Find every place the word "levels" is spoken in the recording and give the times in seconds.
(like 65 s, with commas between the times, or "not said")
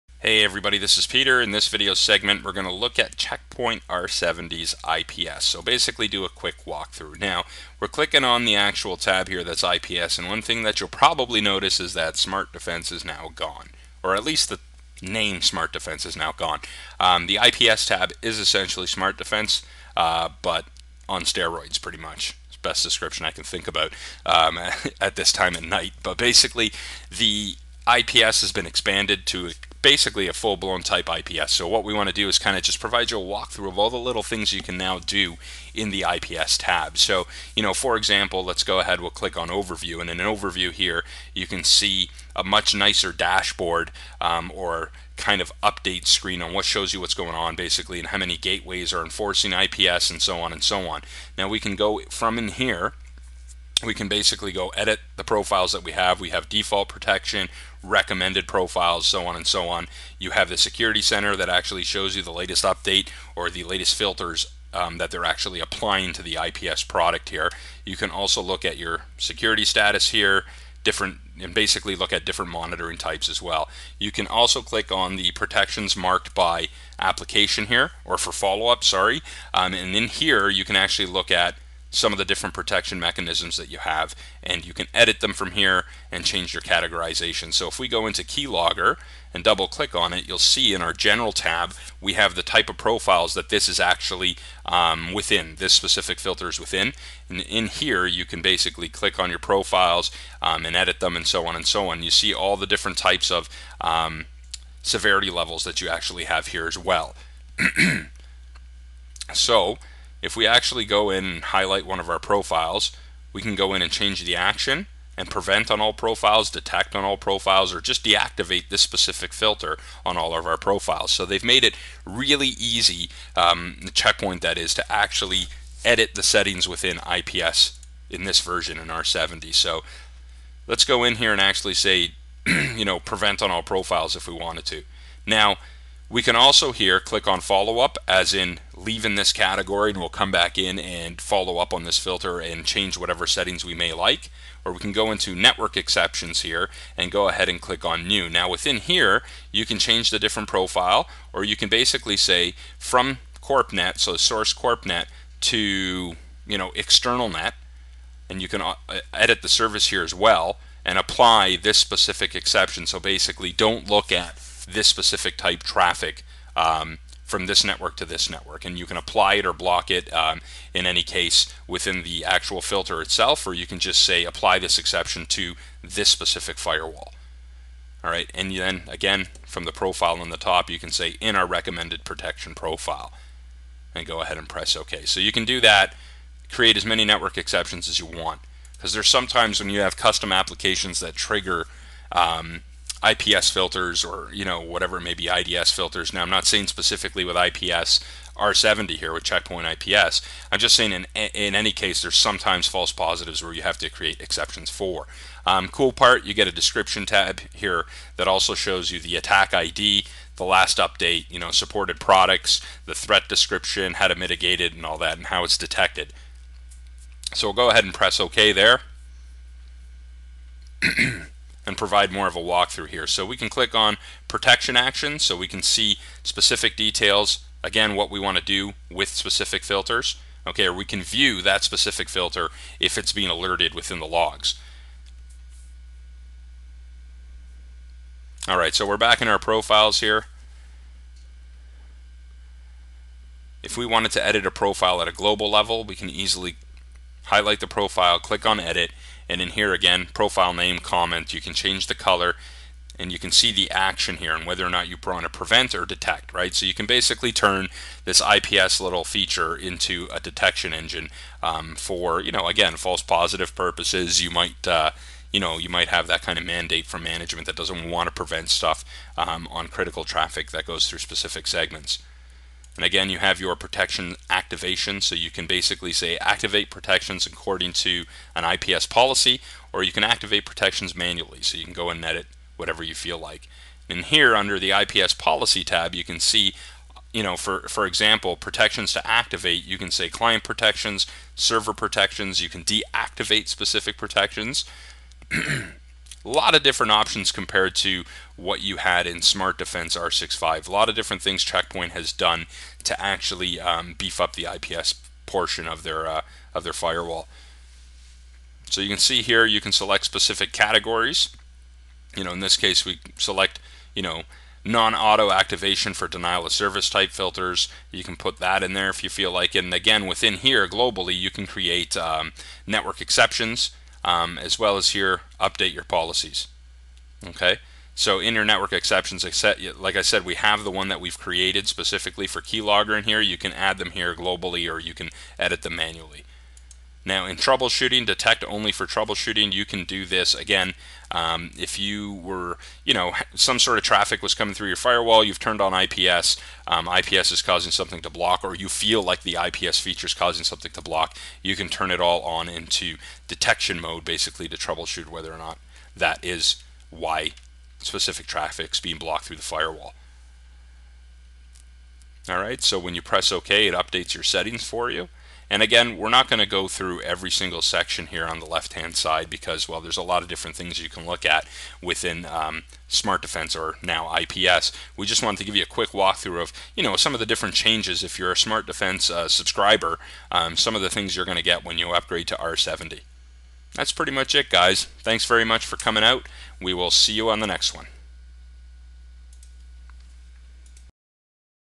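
105 s, 245 s.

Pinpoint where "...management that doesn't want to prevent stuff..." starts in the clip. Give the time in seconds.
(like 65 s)
267 s.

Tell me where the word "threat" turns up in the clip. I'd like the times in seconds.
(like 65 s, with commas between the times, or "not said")
212 s.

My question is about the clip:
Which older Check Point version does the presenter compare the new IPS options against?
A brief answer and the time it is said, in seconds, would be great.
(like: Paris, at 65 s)
R65, at 299 s.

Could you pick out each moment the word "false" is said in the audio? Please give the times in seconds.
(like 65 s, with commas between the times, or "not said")
202 s, 262 s.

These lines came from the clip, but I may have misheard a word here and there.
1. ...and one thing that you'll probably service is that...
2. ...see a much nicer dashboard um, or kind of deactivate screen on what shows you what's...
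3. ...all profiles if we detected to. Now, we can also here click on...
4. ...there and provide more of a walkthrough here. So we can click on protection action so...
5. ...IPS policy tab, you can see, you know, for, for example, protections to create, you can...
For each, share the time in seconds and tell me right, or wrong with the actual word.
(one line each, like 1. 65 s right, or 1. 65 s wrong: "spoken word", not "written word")
1. 10 s wrong: "notice", not "service"
2. 41 s wrong: "update", not "deactivate"
3. 133 s wrong: "wanted", not "detected"
4. 218 s right
5. 284 s wrong: "activate", not "create".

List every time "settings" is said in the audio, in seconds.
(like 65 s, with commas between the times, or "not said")
126 s, 143 s, 364 s.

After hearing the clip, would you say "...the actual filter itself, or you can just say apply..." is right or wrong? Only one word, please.
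right.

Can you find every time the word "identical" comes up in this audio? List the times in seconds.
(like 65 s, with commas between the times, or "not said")
not said.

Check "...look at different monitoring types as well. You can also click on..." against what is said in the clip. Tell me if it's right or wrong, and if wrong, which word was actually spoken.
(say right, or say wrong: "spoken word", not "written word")
right.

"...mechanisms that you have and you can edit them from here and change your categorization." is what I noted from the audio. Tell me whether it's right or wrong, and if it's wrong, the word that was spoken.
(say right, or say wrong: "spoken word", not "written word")
right.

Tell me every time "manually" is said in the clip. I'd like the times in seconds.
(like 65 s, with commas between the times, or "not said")
280 s, 335 s.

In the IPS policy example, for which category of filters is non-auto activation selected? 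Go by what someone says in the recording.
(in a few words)
Denial of service.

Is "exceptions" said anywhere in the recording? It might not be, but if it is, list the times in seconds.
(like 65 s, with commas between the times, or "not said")
145 s, 162 s, 174 s, 187 s, 204 s, 323 s, 328 s.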